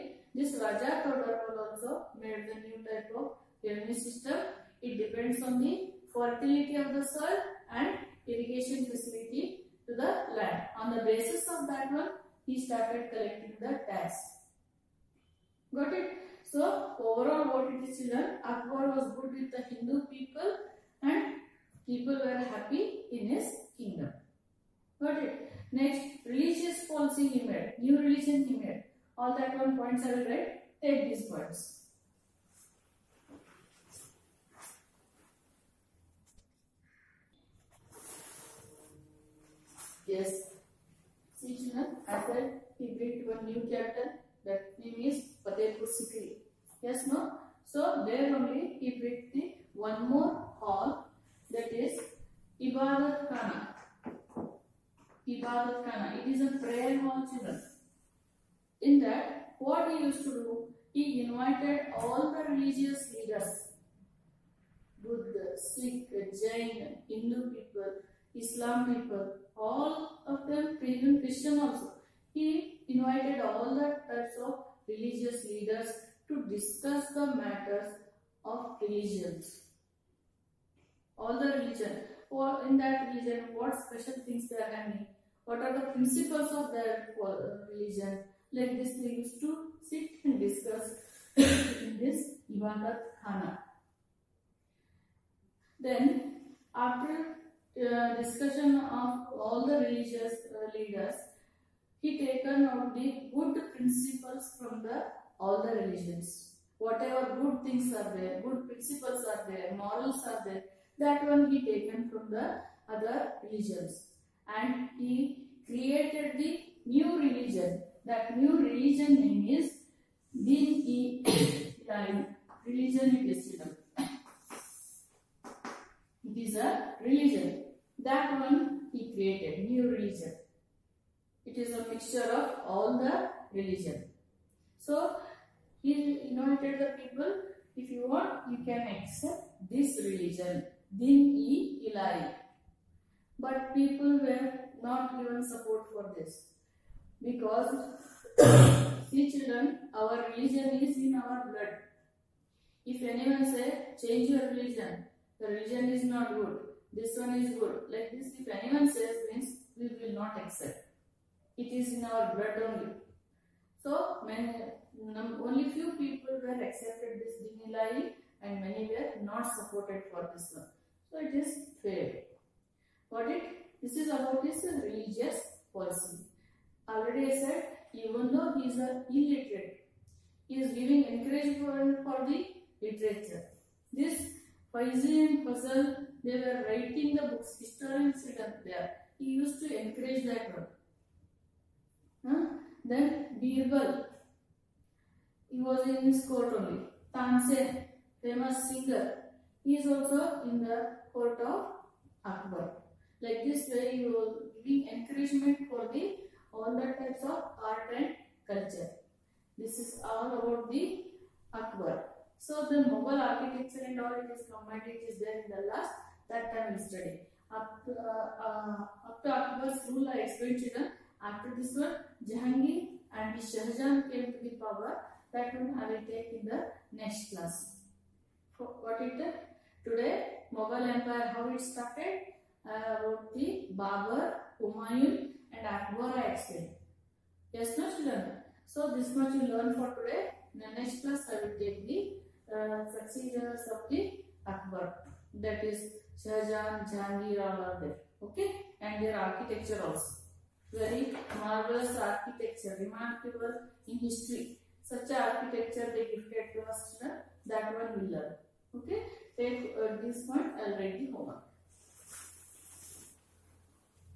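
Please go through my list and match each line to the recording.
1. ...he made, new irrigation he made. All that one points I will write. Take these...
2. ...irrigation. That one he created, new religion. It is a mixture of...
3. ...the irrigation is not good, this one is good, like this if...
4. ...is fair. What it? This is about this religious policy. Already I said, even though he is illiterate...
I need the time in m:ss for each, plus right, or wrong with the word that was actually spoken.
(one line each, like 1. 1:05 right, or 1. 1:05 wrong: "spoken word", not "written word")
1. 0:27 wrong: "religion", not "irrigation"
2. 2:07 wrong: "religion", not "irrigation"
3. 2:35 wrong: "religion", not "irrigation"
4. 2:51 right.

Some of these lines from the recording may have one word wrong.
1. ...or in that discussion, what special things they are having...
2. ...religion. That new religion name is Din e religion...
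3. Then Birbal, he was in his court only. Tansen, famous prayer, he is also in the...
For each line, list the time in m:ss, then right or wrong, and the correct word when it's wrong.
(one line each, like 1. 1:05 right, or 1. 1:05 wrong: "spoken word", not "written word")
1. 1:22 wrong: "religion", not "discussion"
2. 1:57 right
3. 3:12 wrong: "singer", not "prayer".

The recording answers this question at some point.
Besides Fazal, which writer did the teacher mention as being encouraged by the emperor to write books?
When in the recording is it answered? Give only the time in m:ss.
3:04.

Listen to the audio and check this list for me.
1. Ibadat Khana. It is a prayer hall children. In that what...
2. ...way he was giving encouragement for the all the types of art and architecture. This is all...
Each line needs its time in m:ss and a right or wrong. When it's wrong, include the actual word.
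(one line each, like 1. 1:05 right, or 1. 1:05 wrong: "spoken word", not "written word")
1. 0:55 right
2. 3:23 wrong: "culture", not "architecture".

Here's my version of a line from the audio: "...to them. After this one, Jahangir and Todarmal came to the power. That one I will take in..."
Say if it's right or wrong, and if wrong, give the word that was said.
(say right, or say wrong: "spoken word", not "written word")
wrong: "Shahjahan", not "Todarmal".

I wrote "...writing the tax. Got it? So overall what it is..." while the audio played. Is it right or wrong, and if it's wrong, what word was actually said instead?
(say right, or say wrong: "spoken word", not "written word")
wrong: "collecting", not "writing".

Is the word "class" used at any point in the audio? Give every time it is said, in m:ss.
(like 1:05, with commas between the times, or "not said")
3:47, 4:01.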